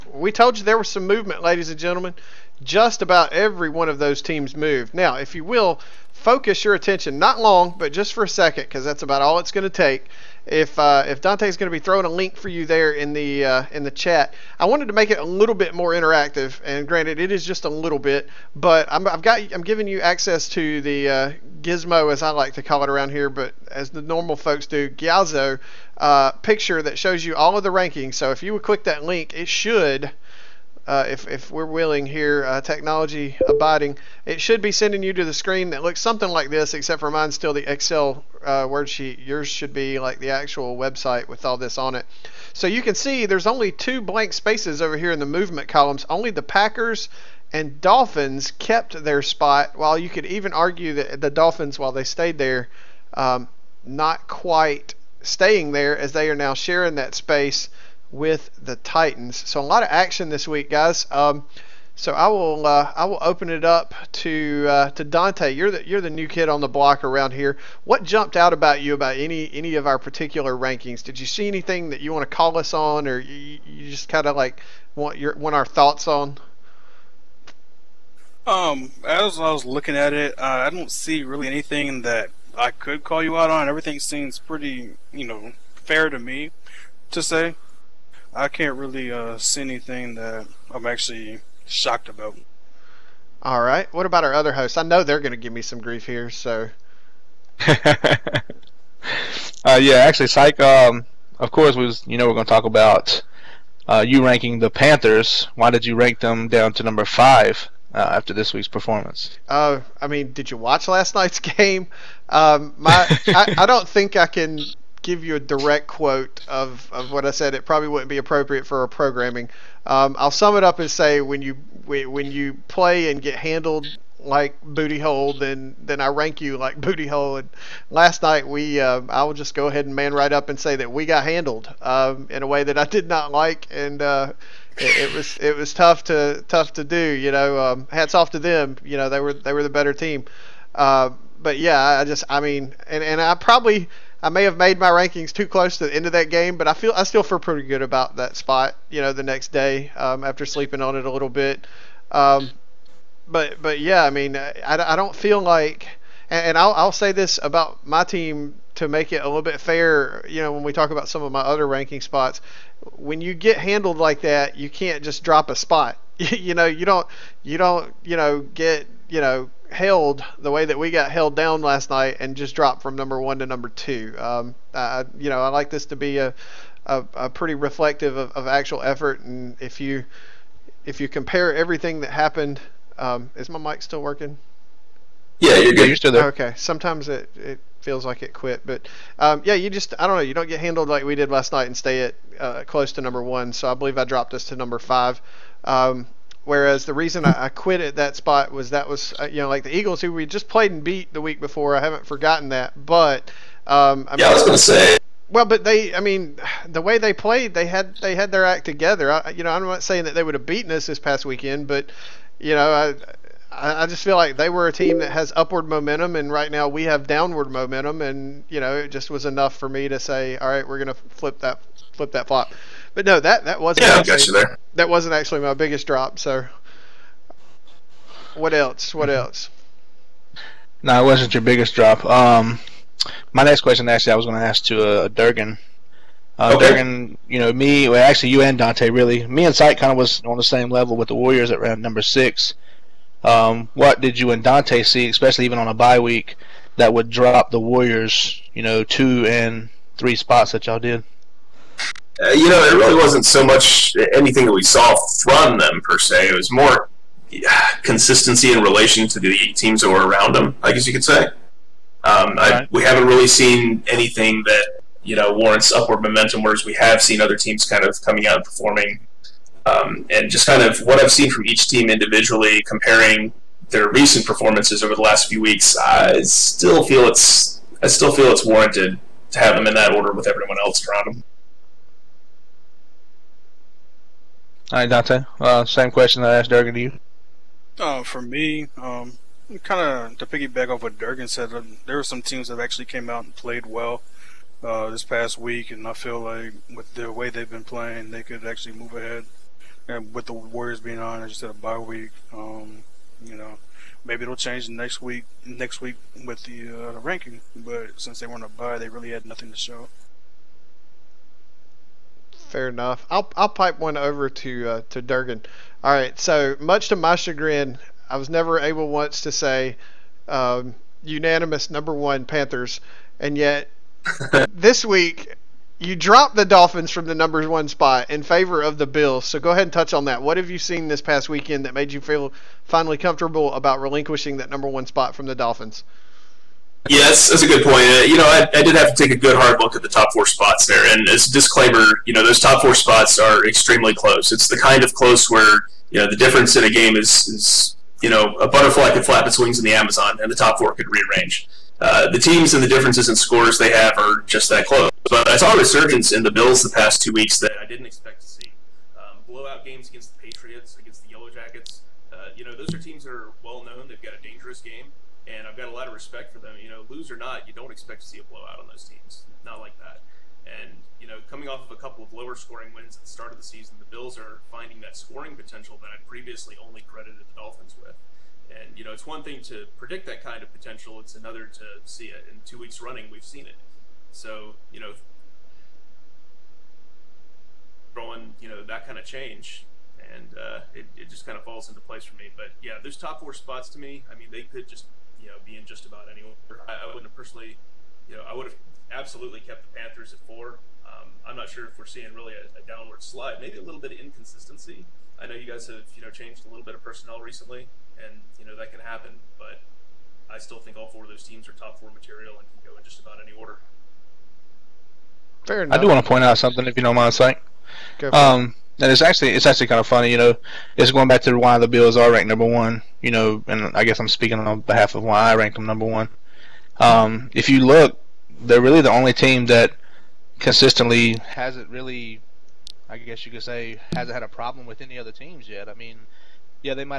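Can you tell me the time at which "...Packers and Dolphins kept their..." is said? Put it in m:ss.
0:46.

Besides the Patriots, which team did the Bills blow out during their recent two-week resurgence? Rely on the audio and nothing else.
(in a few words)
Yellow Jackets.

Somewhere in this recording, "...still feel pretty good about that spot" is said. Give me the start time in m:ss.
2:27.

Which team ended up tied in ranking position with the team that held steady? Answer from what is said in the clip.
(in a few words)
Titans.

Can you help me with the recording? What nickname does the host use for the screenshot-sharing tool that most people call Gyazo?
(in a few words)
gizmo.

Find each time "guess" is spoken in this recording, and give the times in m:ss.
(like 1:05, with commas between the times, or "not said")
4:20, 7:03, 7:12.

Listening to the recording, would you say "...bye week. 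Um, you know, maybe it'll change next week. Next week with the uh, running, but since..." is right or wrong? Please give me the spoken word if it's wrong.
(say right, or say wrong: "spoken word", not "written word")
wrong: "ranking", not "running".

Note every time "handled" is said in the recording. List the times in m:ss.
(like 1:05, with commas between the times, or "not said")
2:03, 2:11, 2:43, 3:10.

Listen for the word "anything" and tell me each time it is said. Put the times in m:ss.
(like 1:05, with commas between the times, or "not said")
1:11, 1:21, 1:29, 4:14, 4:23.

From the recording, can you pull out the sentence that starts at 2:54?
Um, I, you know, I like this to be a, a, a pretty reflective of, of, actual effort.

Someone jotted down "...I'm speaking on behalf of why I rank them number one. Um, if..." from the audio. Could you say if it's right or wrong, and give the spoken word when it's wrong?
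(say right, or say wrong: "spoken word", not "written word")
right.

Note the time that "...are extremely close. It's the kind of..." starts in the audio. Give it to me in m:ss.
5:43.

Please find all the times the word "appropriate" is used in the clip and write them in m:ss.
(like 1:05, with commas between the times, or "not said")
1:58.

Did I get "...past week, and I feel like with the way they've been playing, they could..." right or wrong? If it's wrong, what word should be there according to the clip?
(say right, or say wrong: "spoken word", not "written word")
right.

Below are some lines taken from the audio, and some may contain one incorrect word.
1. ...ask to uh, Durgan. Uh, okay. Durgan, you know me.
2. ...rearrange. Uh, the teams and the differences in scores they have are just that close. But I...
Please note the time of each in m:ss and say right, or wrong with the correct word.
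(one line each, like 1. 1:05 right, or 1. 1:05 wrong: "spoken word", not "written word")
1. 3:54 right
2. 5:50 right.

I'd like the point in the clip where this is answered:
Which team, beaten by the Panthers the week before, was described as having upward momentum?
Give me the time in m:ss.
3:19.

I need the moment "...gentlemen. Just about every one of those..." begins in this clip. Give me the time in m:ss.
0:01.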